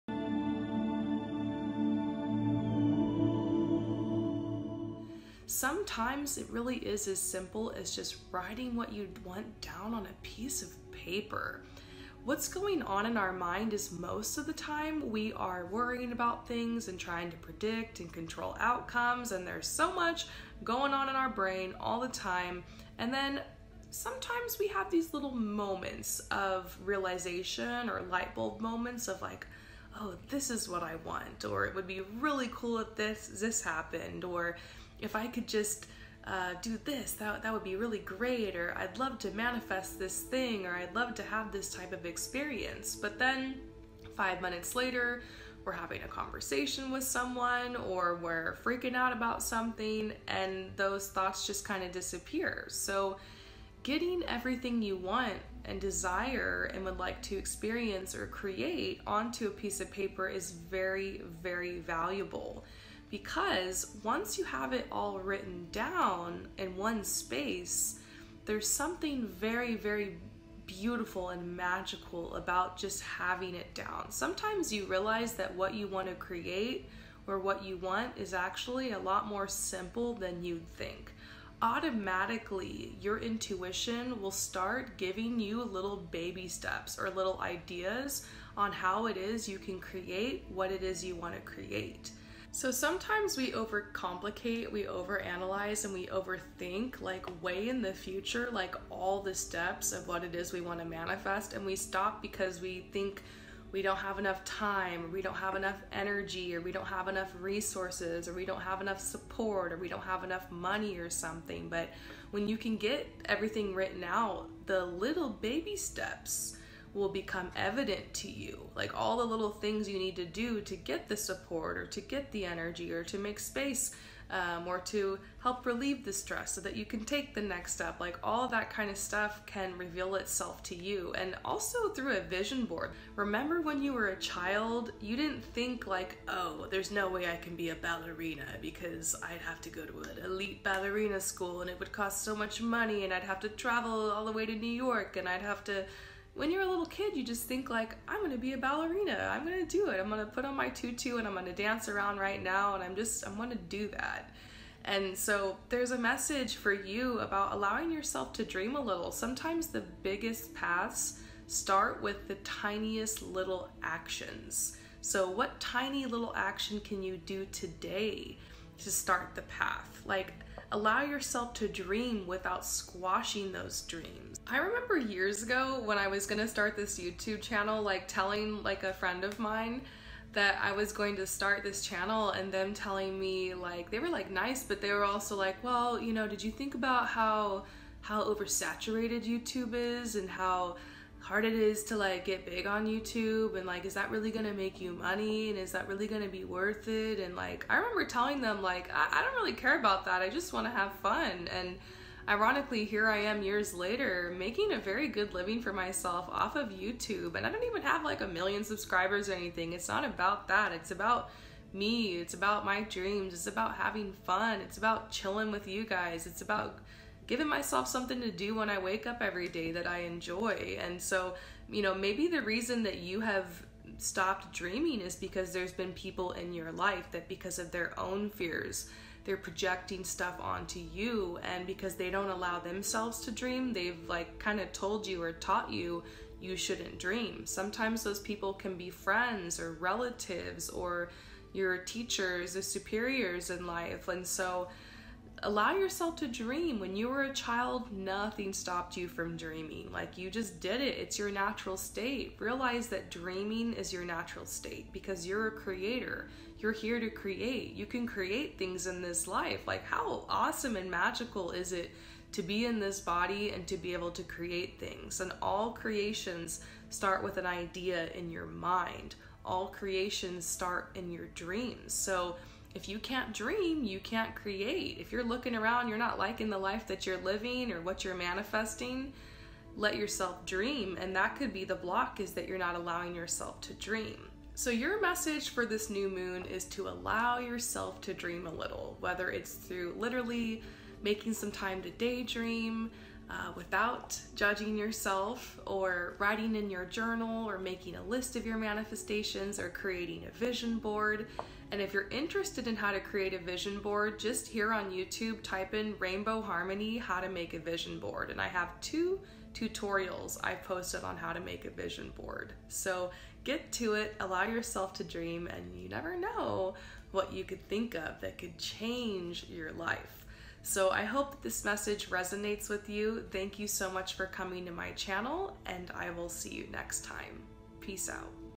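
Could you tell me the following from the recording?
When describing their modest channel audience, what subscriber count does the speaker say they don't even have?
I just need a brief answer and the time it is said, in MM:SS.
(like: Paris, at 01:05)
a million, at 03:28.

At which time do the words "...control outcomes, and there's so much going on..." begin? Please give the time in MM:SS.
00:18.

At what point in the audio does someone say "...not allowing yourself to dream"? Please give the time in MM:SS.
04:42.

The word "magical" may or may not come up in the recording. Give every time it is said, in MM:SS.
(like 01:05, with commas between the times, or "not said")
01:11, 04:20.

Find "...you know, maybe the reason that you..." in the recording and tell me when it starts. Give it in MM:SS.
03:41.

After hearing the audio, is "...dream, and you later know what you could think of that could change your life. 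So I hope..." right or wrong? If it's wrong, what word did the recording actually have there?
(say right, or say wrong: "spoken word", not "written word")
wrong: "never", not "later".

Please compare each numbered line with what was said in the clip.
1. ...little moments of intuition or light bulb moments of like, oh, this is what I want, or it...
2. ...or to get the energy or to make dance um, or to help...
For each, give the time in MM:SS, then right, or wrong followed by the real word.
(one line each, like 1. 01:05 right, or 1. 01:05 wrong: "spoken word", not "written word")
1. 00:25 wrong: "realization", not "intuition"
2. 02:01 wrong: "space", not "dance".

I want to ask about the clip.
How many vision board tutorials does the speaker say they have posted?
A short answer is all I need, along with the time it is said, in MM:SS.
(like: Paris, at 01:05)
2, at 05:08.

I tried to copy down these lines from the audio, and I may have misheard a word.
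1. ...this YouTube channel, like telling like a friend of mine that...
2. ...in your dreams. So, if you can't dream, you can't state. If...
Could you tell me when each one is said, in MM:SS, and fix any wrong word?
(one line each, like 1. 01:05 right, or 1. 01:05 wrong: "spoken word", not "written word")
1. 02:56 right
2. 04:30 wrong: "create", not "state".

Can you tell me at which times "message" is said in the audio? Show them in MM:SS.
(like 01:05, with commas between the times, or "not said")
02:35, 04:45, 05:21.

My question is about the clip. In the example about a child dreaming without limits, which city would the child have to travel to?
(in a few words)
New York.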